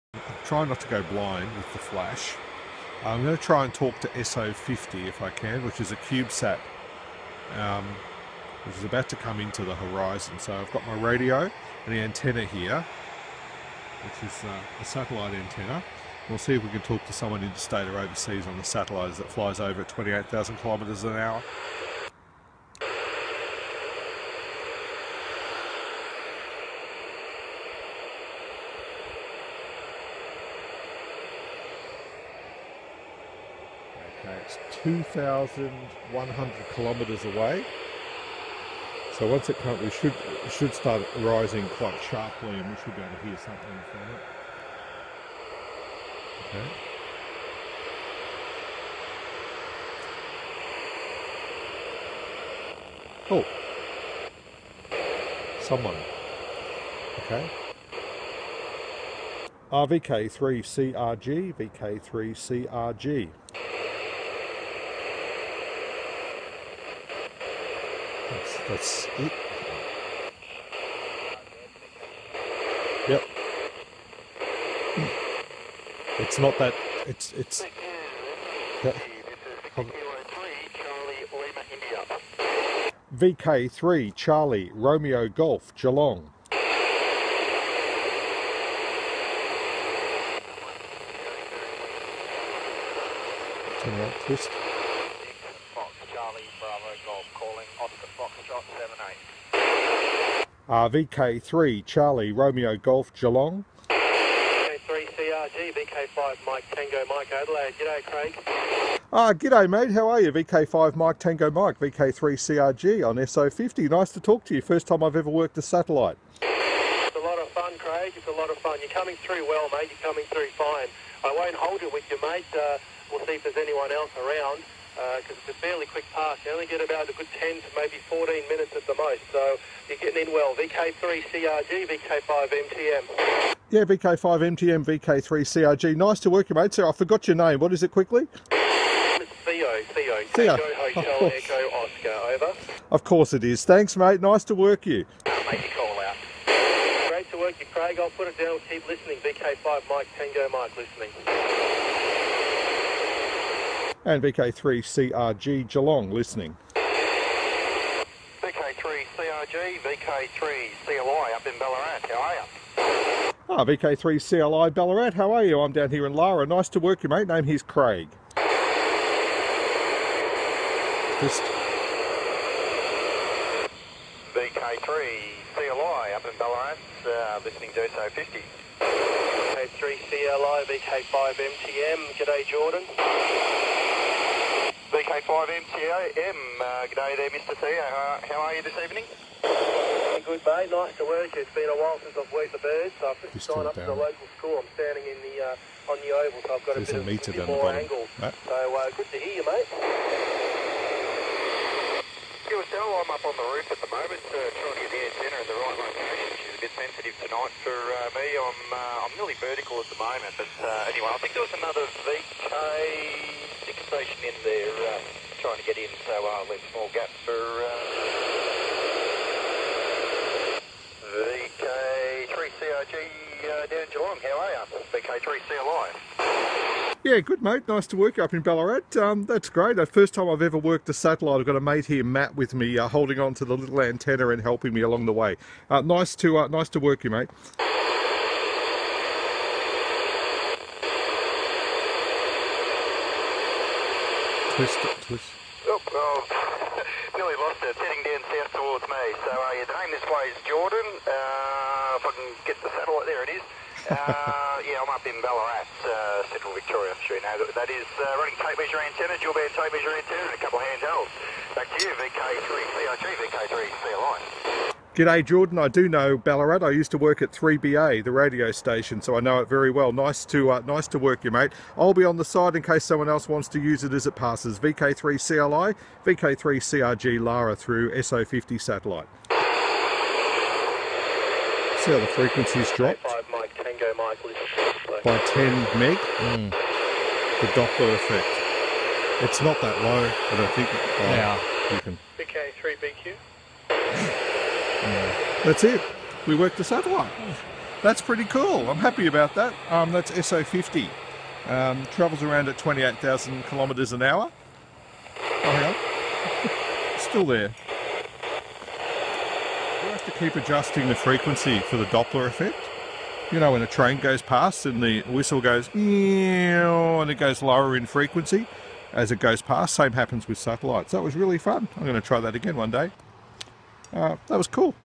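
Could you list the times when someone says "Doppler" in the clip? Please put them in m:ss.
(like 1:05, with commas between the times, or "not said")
4:47, 5:11.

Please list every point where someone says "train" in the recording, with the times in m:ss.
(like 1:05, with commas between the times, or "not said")
5:13.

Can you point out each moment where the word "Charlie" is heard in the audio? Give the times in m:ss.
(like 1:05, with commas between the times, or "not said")
1:24, 1:41.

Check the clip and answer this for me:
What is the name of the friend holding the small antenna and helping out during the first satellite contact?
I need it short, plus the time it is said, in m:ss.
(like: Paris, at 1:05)
Matt, at 3:52.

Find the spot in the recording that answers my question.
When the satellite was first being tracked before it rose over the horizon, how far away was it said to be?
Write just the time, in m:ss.
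0:34.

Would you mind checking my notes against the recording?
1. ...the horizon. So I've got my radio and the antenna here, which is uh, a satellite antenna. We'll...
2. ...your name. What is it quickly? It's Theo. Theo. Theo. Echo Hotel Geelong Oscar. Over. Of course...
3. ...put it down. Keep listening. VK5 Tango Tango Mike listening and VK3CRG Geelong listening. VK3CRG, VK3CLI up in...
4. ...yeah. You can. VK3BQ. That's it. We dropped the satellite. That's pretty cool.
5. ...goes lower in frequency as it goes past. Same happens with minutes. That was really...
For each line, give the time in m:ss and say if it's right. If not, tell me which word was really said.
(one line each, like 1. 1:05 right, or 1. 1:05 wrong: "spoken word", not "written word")
1. 0:09 right
2. 2:17 wrong: "Echo", not "Geelong"
3. 2:28 wrong: "Mike", not "Tango"
4. 4:51 wrong: "worked", not "dropped"
5. 5:17 wrong: "satellites", not "minutes".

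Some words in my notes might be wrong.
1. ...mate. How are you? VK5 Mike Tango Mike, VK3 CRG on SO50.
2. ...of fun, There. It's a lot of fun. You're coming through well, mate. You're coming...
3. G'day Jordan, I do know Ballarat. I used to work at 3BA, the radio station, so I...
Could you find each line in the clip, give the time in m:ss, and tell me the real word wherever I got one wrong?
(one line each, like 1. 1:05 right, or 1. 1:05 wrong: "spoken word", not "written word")
1. 1:49 right
2. 1:57 wrong: "Craig", not "There"
3. 4:24 right.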